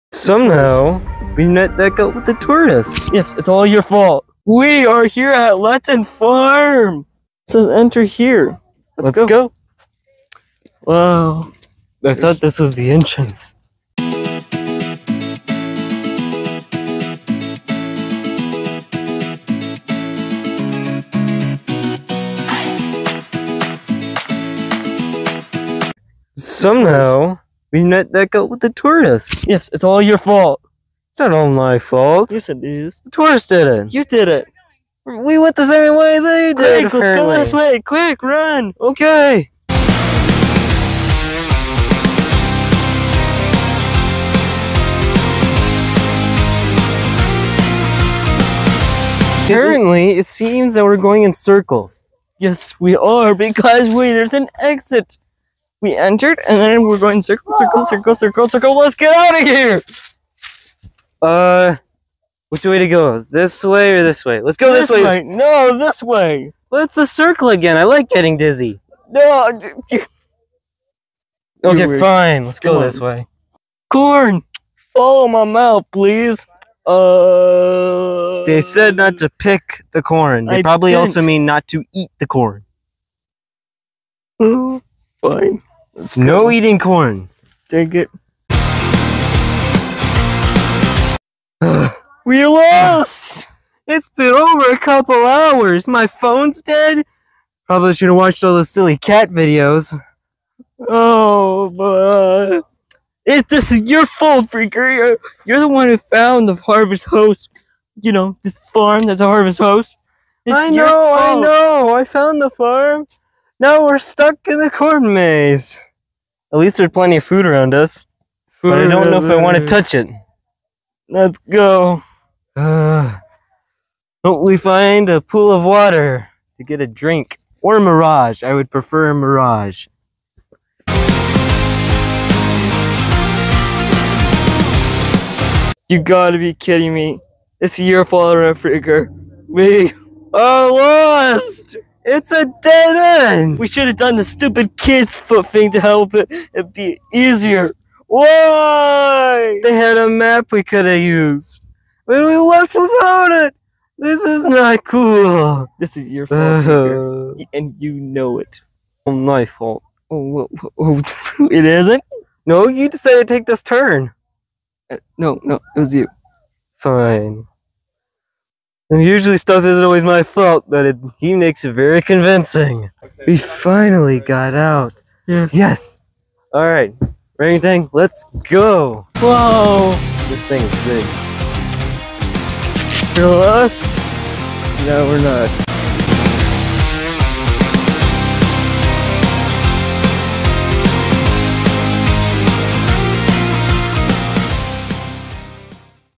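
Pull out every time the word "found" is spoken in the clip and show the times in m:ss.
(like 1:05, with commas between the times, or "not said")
1:45, 1:52.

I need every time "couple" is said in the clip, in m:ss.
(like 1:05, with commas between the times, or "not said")
1:34.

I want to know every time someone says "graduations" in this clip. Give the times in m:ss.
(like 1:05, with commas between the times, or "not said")
not said.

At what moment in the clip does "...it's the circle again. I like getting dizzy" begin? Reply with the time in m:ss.
1:06.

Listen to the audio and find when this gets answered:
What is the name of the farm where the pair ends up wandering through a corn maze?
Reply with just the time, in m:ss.
0:05.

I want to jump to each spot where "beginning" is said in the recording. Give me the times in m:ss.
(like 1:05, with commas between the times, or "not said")
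not said.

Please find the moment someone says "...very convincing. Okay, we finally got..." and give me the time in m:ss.
2:51.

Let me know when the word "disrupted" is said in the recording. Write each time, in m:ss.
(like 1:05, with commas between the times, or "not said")
not said.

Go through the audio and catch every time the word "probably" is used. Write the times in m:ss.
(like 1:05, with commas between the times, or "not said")
1:20, 1:37.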